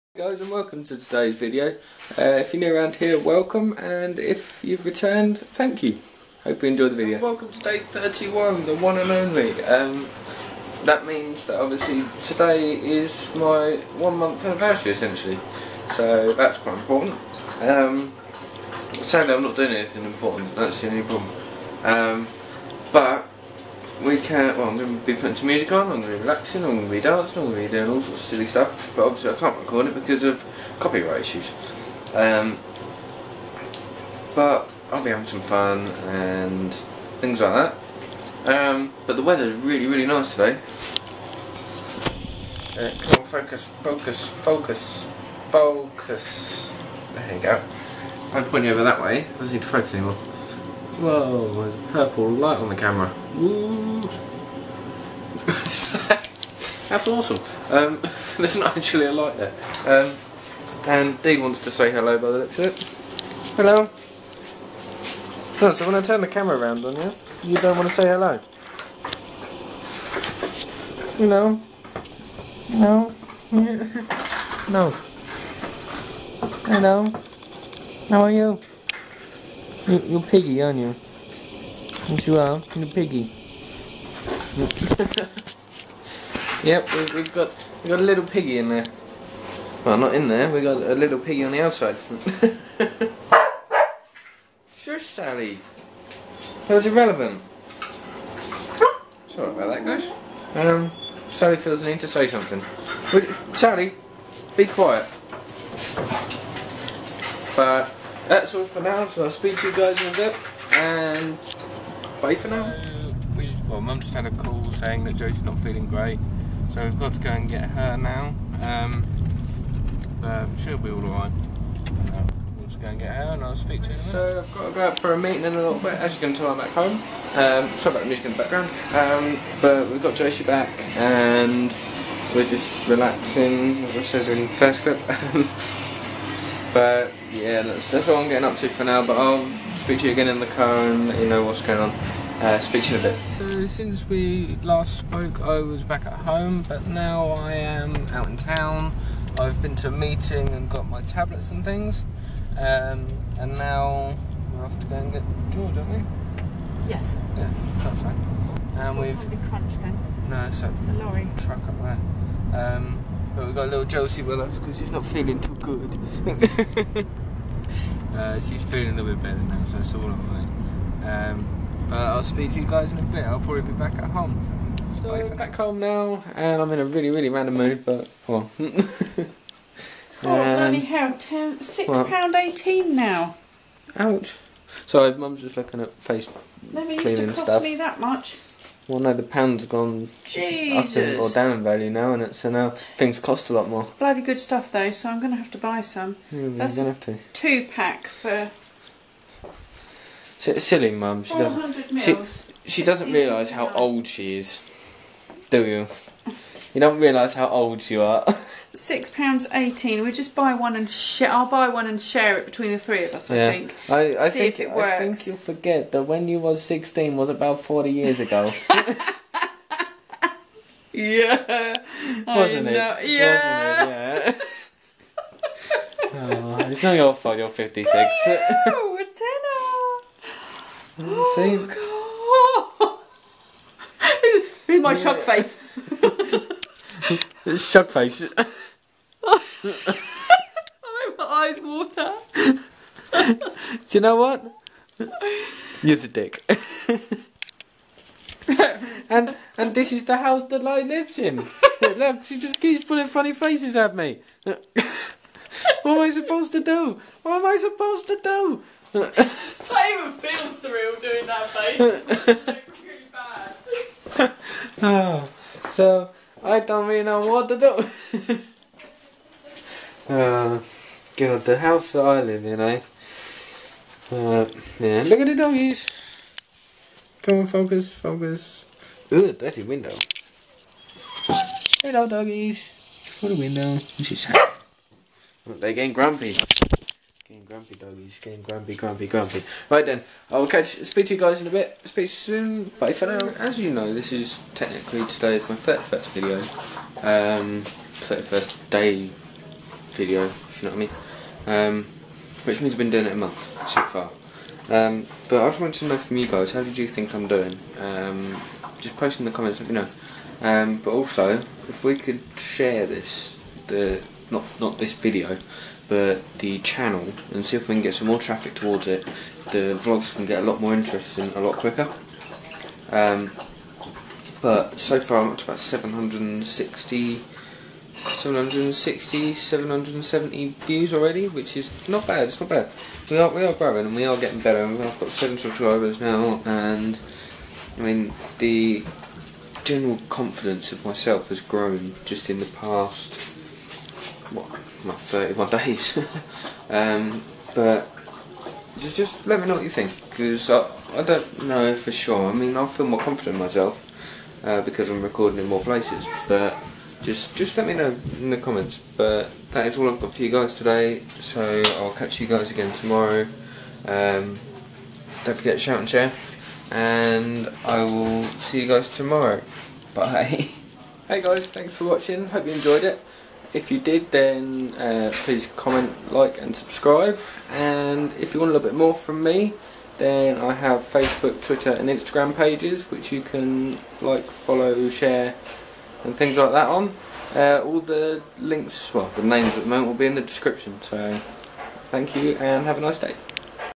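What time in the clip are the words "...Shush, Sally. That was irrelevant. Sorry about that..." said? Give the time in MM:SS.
01:34.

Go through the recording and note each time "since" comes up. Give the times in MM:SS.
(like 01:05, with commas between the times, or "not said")
02:23.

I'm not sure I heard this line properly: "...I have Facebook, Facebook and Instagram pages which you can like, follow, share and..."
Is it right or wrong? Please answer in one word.
wrong.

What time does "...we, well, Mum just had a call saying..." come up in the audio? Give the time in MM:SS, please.
01:53.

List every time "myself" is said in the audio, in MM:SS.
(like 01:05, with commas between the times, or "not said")
05:40, 05:53.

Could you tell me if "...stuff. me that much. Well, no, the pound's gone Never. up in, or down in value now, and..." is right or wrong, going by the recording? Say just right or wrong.
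wrong.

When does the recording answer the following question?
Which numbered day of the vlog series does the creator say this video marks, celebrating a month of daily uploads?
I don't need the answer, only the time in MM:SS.
00:07.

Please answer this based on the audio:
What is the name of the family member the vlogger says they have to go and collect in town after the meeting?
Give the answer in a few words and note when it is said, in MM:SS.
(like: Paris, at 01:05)
George, at 02:35.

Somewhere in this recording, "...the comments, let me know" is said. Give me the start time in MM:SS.
05:09.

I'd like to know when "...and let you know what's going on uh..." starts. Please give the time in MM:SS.
02:20.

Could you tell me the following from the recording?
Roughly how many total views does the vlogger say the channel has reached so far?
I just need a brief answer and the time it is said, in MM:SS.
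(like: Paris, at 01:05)
770, at 05:29.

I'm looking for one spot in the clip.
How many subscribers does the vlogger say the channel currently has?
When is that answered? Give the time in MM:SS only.
05:35.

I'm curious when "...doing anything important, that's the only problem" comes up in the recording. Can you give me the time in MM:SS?
00:19.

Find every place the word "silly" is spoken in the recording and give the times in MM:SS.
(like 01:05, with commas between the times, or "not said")
00:28, 03:20.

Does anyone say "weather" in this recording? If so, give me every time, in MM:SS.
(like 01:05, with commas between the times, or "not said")
00:39.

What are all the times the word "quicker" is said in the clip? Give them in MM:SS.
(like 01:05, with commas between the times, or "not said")
05:21.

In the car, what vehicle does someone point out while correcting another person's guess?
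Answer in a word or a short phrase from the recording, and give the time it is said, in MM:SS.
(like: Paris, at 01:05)
lorry, at 02:40.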